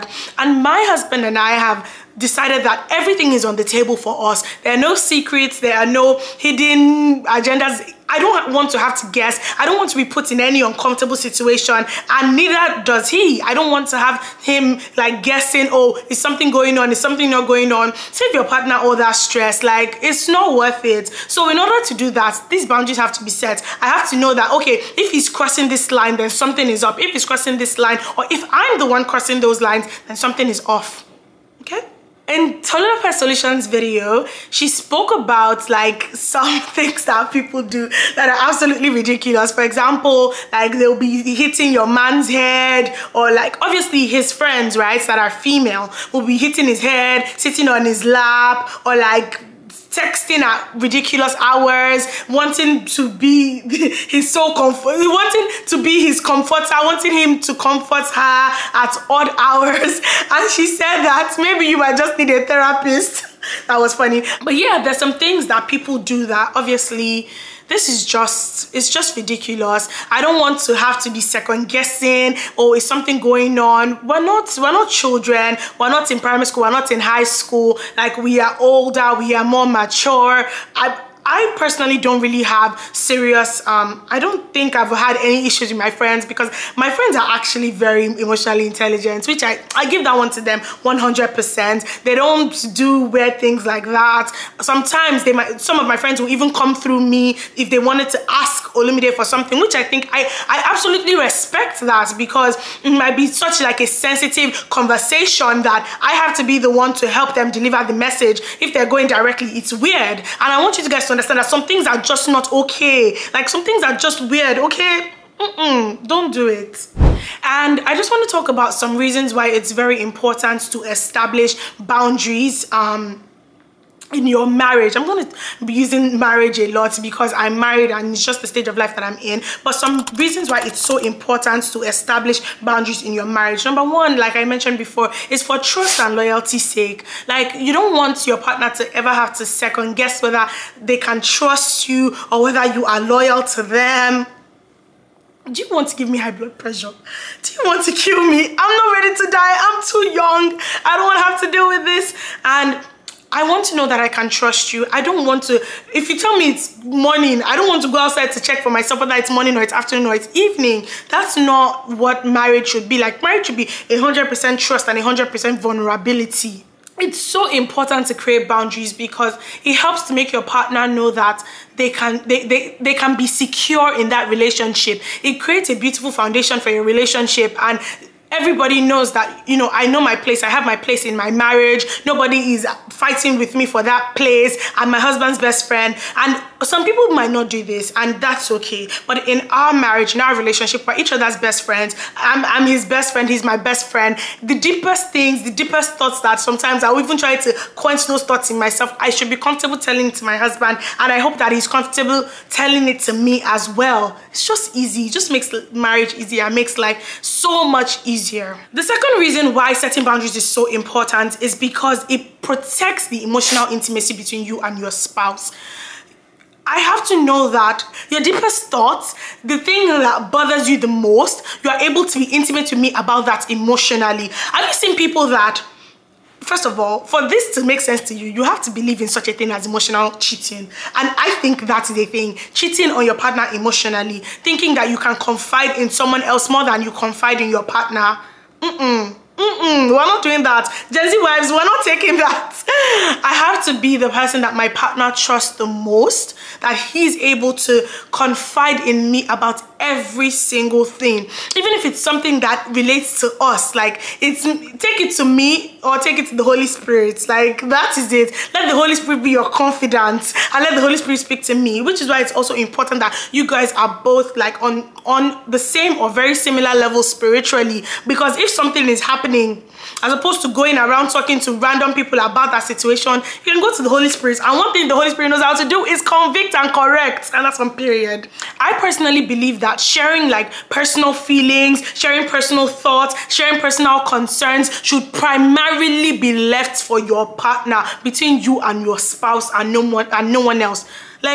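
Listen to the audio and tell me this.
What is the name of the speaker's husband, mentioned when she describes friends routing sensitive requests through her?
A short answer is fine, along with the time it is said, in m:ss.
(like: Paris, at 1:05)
Olumide, at 1:38.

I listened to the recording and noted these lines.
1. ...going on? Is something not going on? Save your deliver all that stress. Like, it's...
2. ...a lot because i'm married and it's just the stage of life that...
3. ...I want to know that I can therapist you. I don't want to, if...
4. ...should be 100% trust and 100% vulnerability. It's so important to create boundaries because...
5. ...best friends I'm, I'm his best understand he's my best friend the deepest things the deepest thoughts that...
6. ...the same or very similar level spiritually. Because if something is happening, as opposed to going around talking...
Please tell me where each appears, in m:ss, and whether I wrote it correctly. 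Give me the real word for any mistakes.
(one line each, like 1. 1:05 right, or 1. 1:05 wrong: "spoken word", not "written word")
1. 0:16 wrong: "partner", not "deliver"
2. 2:06 right
3. 2:33 wrong: "trust", not "therapist"
4. 2:43 right
5. 3:11 wrong: "friend", not "understand"
6. 4:25 right.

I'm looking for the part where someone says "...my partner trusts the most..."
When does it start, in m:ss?
4:04.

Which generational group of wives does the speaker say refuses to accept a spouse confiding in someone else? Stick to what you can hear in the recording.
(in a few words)
Gen Z.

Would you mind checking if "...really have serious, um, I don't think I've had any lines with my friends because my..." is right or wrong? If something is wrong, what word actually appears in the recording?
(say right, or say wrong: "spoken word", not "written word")
wrong: "issues", not "lines".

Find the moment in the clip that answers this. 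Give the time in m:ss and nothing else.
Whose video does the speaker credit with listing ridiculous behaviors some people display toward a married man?
0:32.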